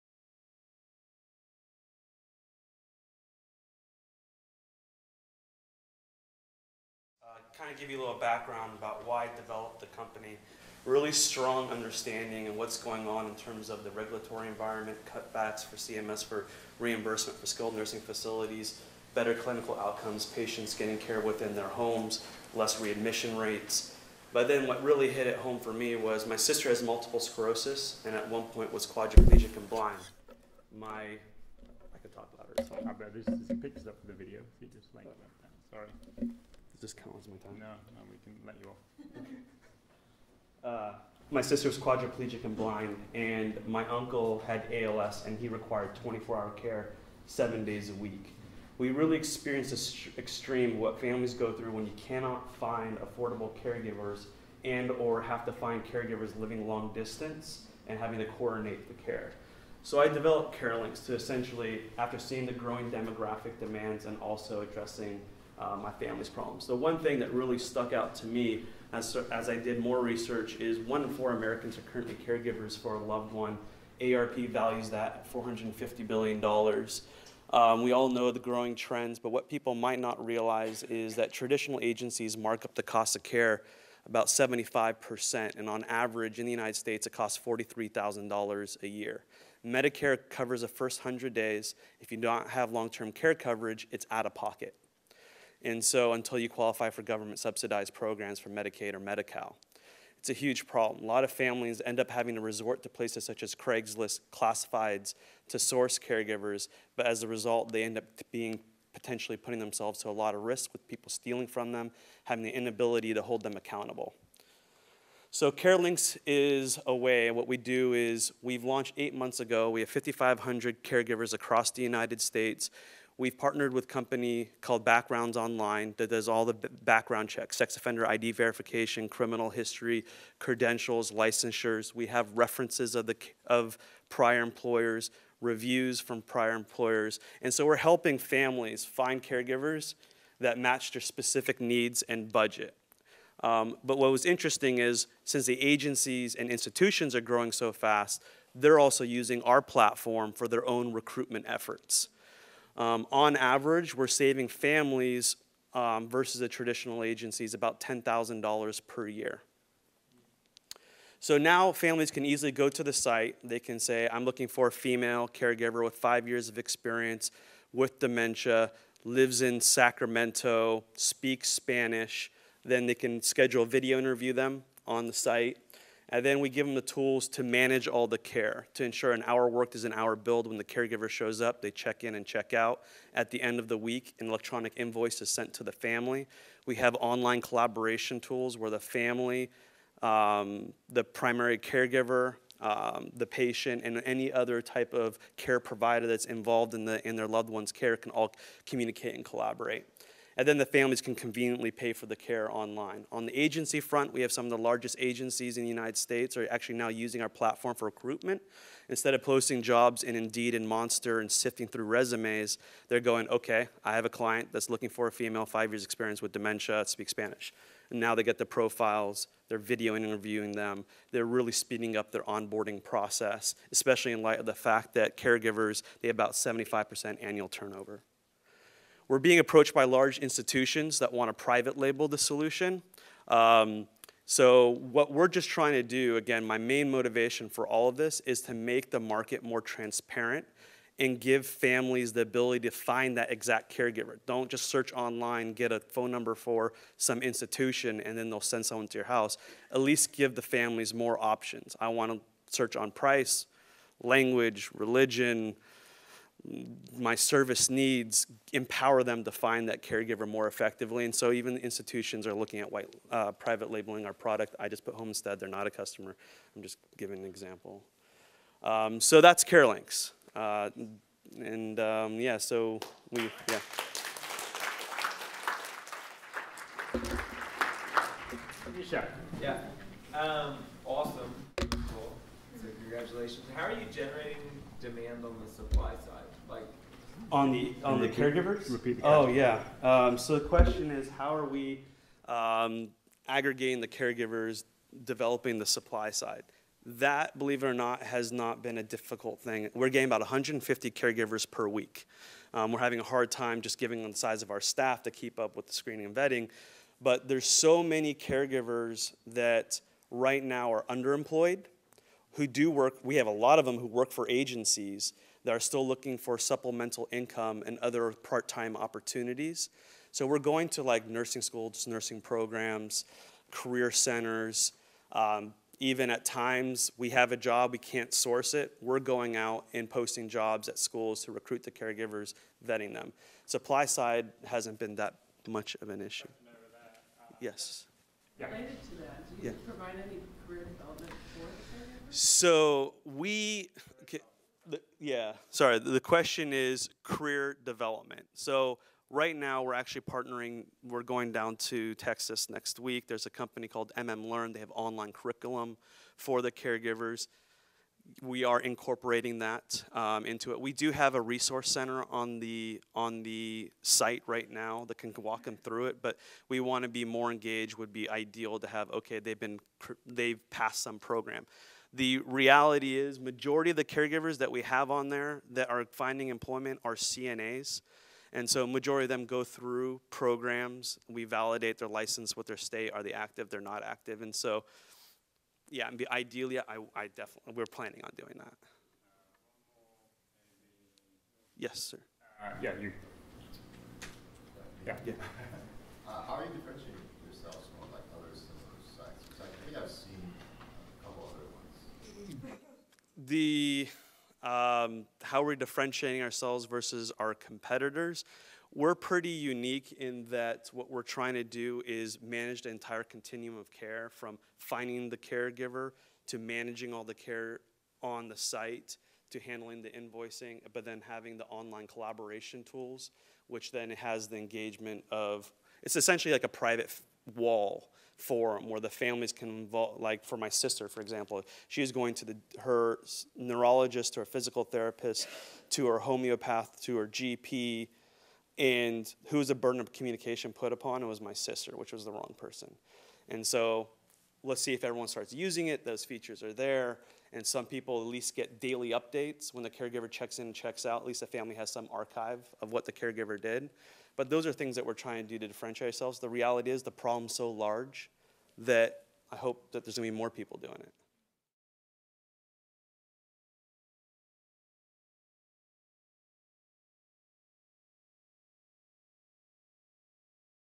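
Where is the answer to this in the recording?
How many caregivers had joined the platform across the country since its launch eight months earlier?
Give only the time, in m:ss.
1:59.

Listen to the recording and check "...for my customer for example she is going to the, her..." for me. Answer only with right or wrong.
wrong.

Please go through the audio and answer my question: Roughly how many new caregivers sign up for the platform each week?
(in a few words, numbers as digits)
150.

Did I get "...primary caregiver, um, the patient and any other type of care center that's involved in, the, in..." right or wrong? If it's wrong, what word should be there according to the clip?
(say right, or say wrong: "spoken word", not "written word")
wrong: "provider", not "center".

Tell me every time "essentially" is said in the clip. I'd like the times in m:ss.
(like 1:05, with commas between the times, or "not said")
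1:01, 7:05.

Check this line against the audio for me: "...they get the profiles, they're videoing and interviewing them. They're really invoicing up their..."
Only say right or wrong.
wrong.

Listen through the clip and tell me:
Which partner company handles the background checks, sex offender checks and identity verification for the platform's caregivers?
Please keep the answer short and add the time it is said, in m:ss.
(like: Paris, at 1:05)
Backgrounds Online, at 2:04.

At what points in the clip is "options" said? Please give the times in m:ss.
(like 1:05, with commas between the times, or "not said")
4:11.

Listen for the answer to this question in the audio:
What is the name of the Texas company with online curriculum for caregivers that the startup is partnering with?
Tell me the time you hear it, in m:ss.
5:53.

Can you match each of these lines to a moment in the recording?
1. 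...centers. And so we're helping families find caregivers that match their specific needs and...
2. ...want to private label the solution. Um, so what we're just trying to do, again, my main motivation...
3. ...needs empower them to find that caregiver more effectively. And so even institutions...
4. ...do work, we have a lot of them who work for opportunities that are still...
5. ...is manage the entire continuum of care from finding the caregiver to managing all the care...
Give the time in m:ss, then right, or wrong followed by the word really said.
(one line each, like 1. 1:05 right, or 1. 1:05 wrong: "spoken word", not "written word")
1. 2:16 wrong: "employers", not "centers"
2. 3:51 right
3. 4:17 right
4. 5:12 wrong: "agencies", not "opportunities"
5. 6:51 right.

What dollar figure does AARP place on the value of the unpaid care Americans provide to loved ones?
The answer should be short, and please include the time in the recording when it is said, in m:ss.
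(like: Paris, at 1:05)
$450 billion, at 1:15.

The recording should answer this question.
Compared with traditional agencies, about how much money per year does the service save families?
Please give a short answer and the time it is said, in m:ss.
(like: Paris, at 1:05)
$10,000, at 2:37.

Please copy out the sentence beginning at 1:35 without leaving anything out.
And so until you qualify for government subsidized programs for Medicaid or Medi-Cal, it's a huge problem.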